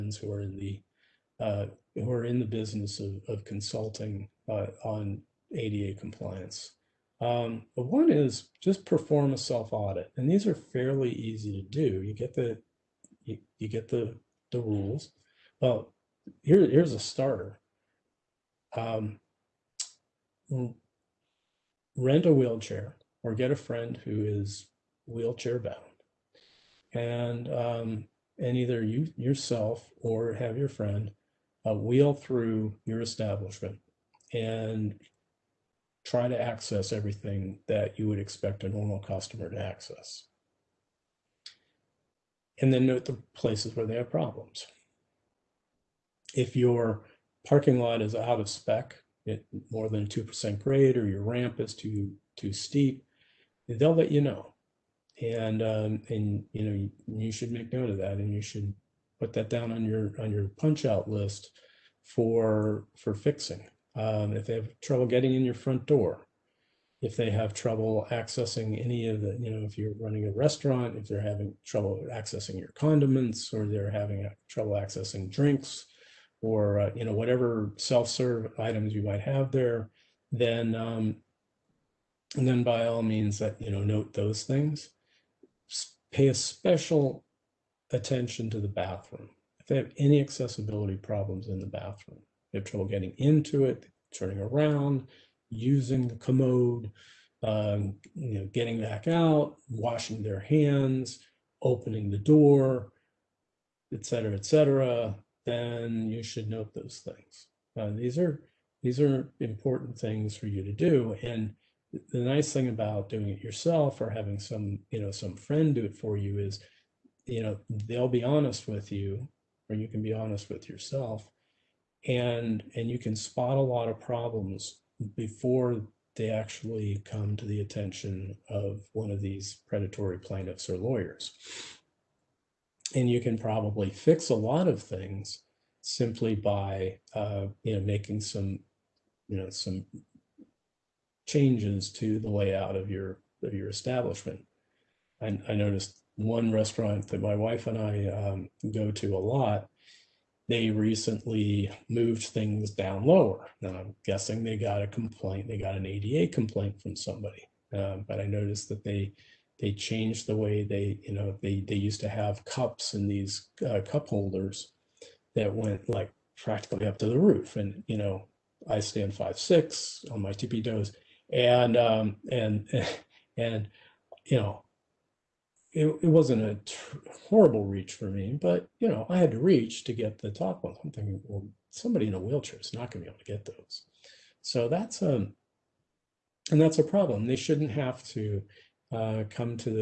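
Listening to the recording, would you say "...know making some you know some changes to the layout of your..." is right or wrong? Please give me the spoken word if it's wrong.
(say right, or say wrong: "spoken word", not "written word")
right.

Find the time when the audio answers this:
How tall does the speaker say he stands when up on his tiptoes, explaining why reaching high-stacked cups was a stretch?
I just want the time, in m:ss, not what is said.
2:49.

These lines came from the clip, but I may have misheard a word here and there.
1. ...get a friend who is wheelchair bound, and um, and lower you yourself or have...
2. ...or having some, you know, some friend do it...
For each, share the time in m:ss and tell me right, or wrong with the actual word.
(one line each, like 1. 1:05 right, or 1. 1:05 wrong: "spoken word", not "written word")
1. 0:23 wrong: "either", not "lower"
2. 1:53 right.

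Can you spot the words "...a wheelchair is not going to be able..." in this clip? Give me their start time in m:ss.
3:02.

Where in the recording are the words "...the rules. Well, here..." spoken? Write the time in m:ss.
0:14.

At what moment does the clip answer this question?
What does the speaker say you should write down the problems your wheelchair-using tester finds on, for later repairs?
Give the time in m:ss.
1:00.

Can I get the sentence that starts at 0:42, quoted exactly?
And then note the places where they have problems.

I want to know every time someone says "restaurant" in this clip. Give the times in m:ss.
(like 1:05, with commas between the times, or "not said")
1:10, 2:26.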